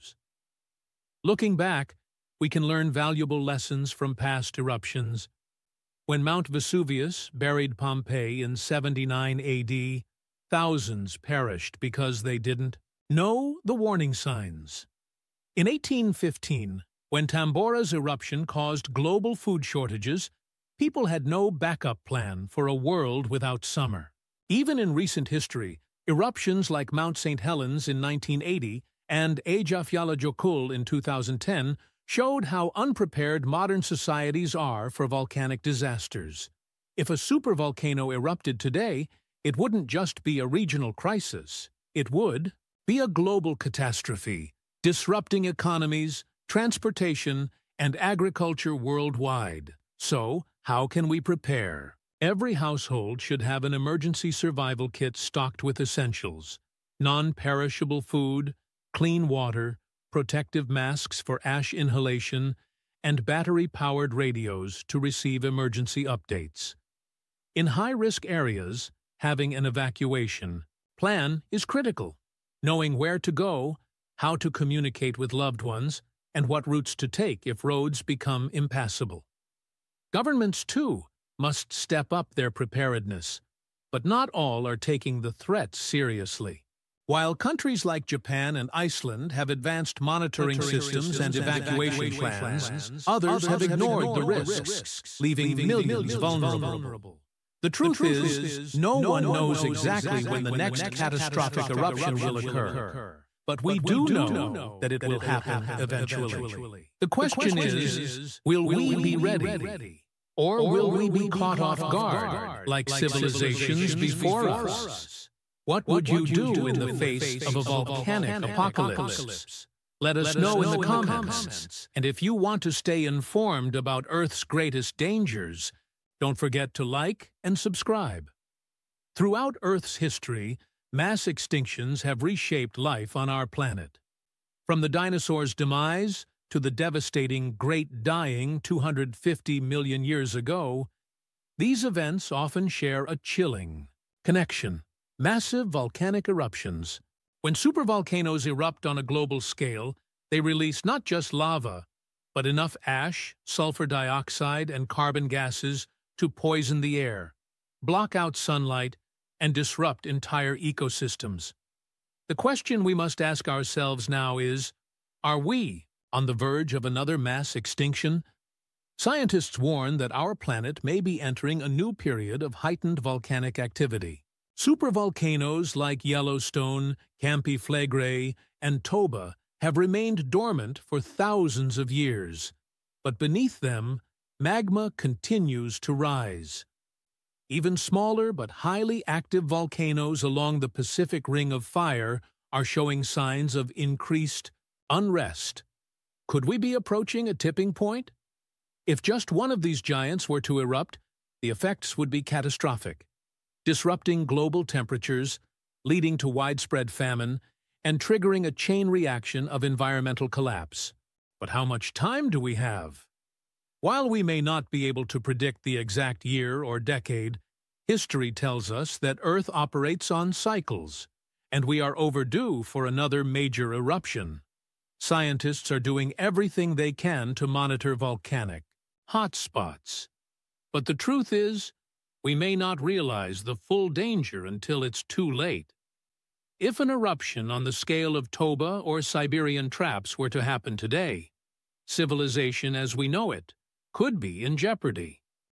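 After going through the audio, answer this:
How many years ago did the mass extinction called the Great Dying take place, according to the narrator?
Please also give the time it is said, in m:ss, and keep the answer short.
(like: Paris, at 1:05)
250 million years, at 2:18.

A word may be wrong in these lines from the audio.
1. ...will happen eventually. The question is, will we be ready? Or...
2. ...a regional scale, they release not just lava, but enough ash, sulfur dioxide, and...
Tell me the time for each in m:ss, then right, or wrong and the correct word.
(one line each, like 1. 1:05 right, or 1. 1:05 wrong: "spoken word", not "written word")
1. 1:45 right
2. 2:28 wrong: "global", not "regional".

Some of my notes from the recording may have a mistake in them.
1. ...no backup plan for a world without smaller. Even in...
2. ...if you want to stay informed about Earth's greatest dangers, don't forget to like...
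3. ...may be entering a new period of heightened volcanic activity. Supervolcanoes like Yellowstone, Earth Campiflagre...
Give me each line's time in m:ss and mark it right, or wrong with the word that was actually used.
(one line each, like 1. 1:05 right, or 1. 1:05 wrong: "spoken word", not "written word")
1. 0:21 wrong: "summer", not "smaller"
2. 2:02 right
3. 2:50 wrong: "Campi", not "Earth".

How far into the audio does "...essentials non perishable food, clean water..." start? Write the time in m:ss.
0:55.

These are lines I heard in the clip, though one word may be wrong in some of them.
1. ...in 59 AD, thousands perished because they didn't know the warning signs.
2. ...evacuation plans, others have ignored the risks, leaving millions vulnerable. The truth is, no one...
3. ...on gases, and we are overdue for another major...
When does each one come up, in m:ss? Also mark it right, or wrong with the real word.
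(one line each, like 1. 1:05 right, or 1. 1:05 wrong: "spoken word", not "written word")
1. 0:08 wrong: "79", not "59"
2. 1:31 right
3. 3:40 wrong: "cycles", not "gases".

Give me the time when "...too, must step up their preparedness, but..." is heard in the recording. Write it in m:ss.
1:20.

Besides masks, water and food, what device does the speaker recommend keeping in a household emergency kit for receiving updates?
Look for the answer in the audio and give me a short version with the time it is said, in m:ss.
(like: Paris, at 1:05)
Battery-powered radios, at 1:03.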